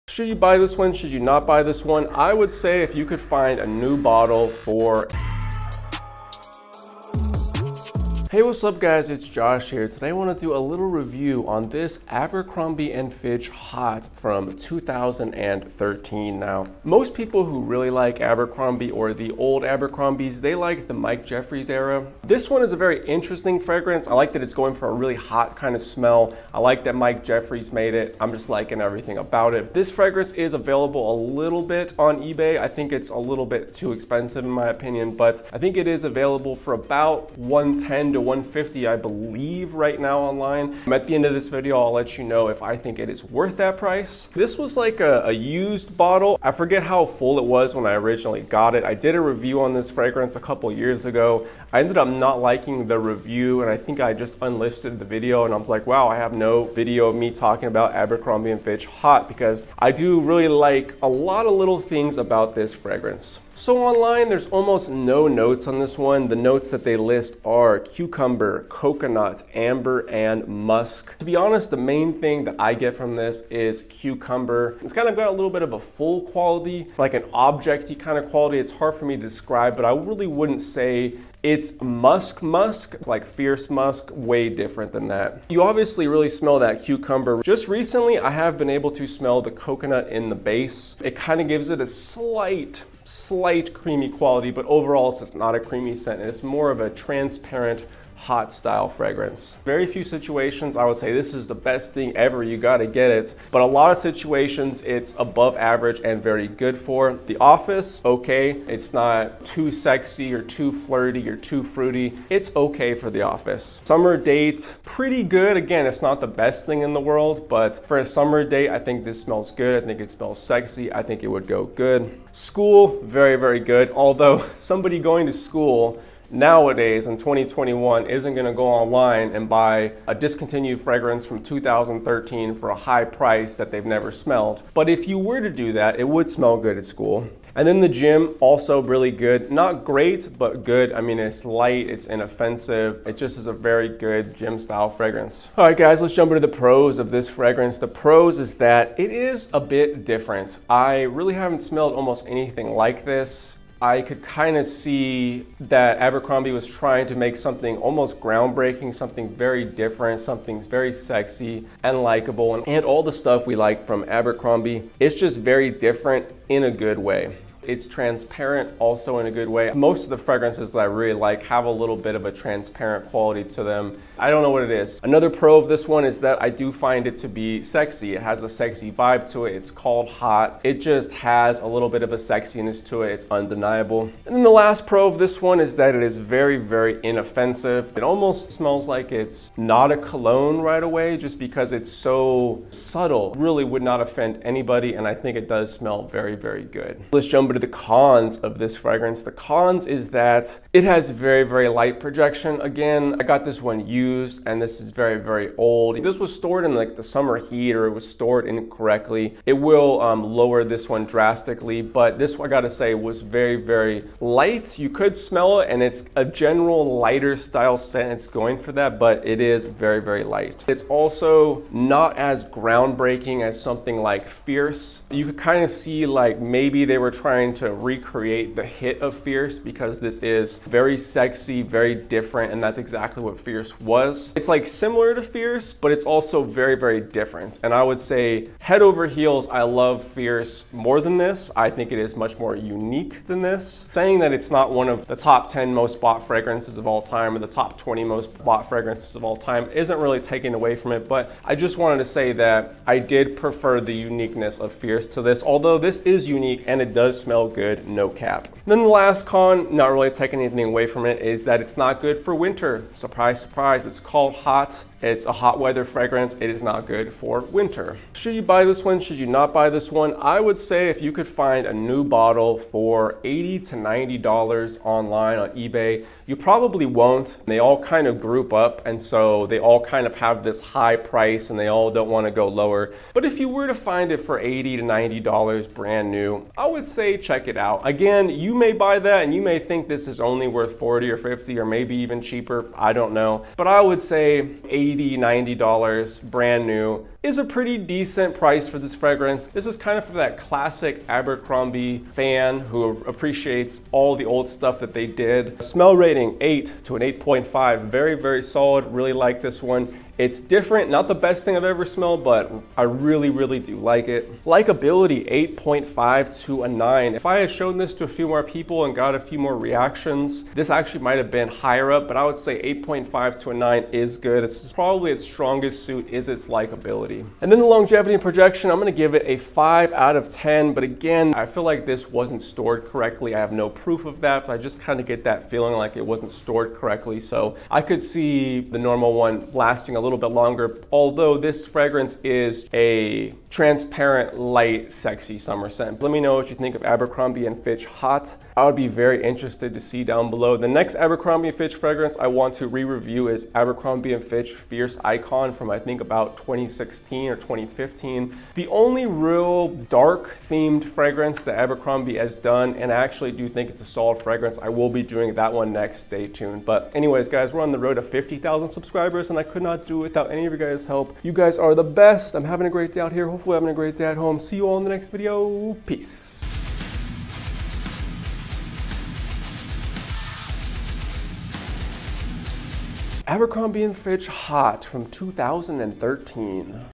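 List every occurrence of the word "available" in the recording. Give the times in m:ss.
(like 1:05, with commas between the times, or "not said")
0:30, 0:36.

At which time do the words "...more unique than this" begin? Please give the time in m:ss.
4:02.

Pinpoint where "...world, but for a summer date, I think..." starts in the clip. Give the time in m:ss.
1:56.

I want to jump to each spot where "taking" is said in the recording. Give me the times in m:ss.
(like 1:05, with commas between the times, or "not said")
4:10, 4:20.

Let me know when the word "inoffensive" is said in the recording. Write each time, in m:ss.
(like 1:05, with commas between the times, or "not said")
2:22, 3:07.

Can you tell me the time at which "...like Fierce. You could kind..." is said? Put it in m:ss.
3:43.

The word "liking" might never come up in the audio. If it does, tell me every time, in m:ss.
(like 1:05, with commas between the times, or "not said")
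0:28, 0:52.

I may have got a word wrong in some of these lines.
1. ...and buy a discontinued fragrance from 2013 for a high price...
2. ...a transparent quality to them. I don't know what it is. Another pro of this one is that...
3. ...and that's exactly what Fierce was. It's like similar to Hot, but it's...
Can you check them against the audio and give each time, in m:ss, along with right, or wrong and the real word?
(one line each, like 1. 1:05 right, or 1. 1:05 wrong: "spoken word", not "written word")
1. 2:09 right
2. 2:52 right
3. 3:52 wrong: "Fierce", not "Hot".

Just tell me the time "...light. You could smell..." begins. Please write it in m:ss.
3:34.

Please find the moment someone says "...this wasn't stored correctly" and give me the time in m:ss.
5:31.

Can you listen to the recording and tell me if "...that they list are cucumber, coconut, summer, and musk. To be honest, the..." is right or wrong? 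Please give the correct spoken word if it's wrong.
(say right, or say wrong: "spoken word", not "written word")
wrong: "amber", not "summer".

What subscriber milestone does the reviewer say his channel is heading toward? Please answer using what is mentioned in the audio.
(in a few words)
50,000.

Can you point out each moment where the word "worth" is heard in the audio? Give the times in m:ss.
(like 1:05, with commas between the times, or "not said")
0:43, 4:50.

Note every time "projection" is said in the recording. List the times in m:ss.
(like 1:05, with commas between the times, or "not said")
3:21, 5:28.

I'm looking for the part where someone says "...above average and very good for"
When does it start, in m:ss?
1:45.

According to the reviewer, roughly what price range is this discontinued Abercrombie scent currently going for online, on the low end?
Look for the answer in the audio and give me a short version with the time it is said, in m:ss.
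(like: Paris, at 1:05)
110 to 150, at 0:36.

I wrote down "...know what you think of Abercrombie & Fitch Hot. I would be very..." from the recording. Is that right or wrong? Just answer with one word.
right.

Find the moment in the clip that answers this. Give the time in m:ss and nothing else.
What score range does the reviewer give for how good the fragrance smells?
5:06.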